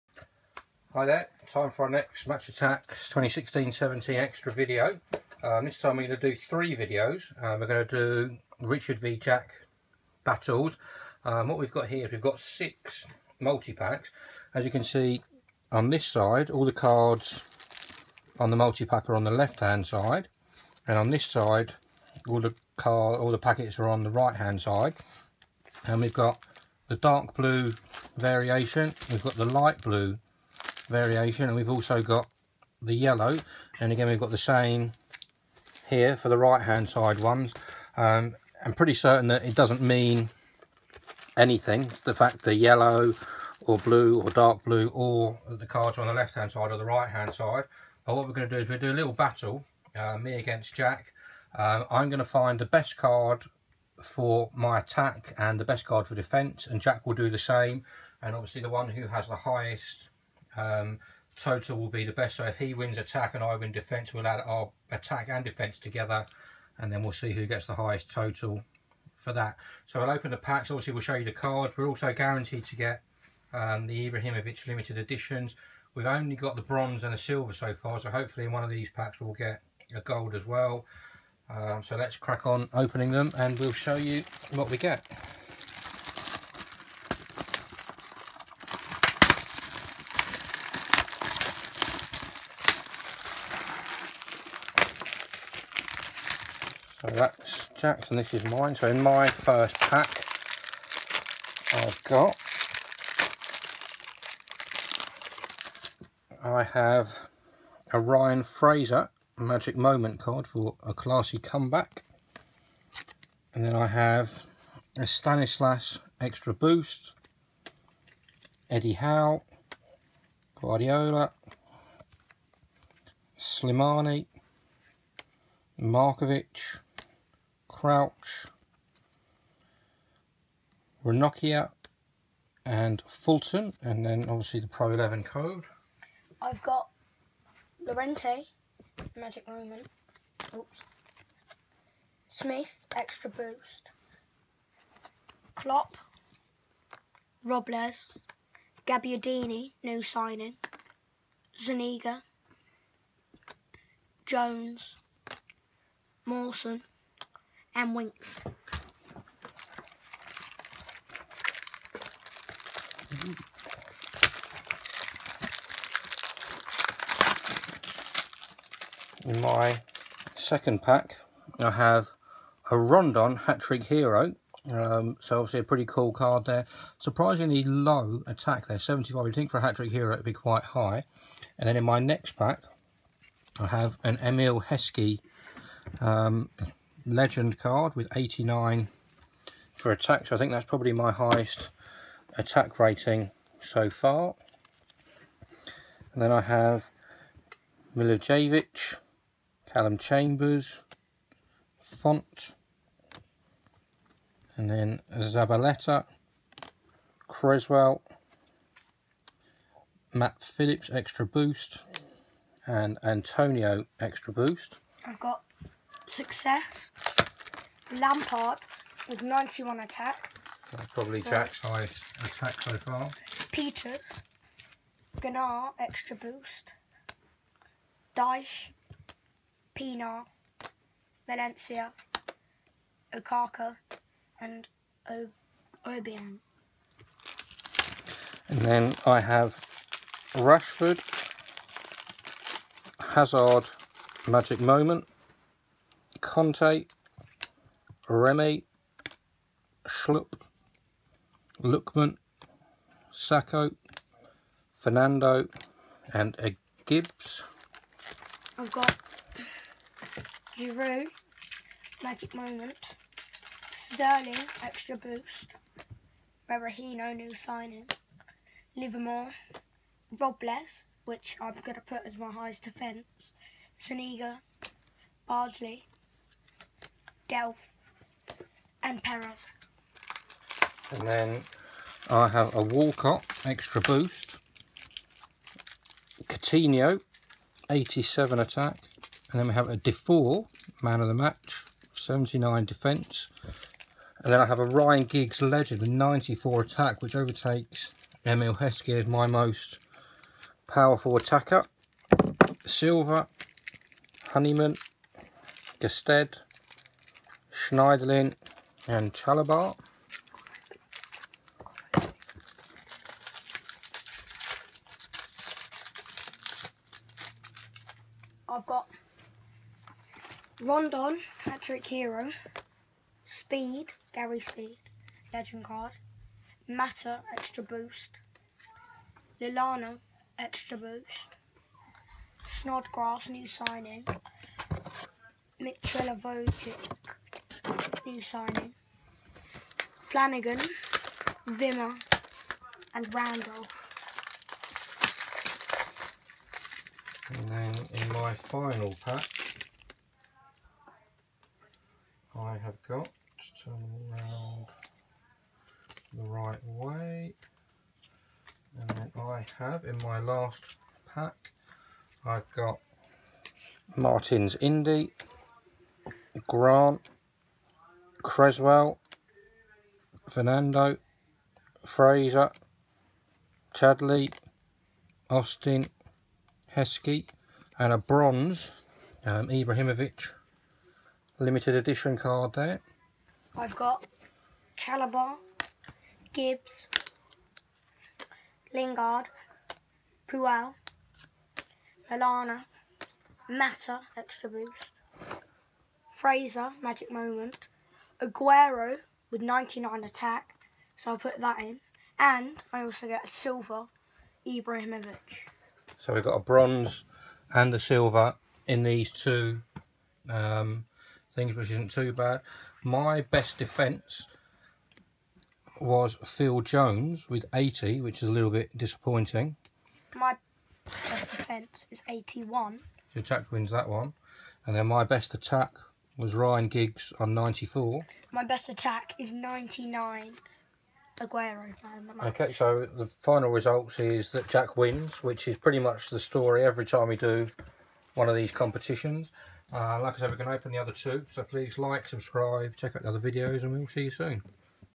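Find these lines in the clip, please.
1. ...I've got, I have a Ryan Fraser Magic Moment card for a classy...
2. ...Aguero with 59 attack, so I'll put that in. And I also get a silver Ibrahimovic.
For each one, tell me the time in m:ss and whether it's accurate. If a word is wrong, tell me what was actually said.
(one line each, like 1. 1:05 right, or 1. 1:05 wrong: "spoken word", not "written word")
1. 1:41 right
2. 6:38 wrong: "99", not "59".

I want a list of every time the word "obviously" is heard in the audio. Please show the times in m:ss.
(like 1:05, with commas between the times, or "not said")
0:58, 1:10, 2:14, 2:55.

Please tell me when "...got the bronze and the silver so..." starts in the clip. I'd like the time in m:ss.
1:16.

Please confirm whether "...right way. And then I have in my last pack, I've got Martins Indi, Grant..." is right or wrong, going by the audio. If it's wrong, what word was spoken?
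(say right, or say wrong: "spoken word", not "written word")
right.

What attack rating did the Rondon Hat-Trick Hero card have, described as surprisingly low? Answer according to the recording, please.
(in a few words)
75.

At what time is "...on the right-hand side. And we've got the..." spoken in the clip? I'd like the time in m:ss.
0:23.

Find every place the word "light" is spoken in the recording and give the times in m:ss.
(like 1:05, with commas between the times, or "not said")
0:29.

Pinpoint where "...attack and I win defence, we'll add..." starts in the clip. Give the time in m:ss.
1:02.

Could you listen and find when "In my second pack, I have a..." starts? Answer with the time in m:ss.
2:49.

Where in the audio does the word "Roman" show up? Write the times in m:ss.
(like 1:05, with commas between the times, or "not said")
2:19.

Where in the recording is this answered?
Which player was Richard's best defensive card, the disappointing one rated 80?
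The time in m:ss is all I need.
6:56.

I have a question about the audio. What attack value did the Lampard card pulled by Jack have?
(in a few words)
91.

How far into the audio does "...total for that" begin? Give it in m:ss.
1:08.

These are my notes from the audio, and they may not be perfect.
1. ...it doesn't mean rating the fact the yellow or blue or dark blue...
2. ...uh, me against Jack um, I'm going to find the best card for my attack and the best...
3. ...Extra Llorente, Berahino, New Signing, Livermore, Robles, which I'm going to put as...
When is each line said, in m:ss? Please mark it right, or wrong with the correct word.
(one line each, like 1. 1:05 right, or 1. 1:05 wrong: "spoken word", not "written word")
1. 0:39 wrong: "anything", not "rating"
2. 0:49 right
3. 4:24 wrong: "Boost", not "Llorente".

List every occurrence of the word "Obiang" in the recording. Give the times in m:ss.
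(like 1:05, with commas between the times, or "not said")
3:55.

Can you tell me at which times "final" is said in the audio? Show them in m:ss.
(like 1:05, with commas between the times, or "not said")
5:48, 7:13.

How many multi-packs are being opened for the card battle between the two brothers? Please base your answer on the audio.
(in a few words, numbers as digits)
6.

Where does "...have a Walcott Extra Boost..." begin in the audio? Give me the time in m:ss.
4:42.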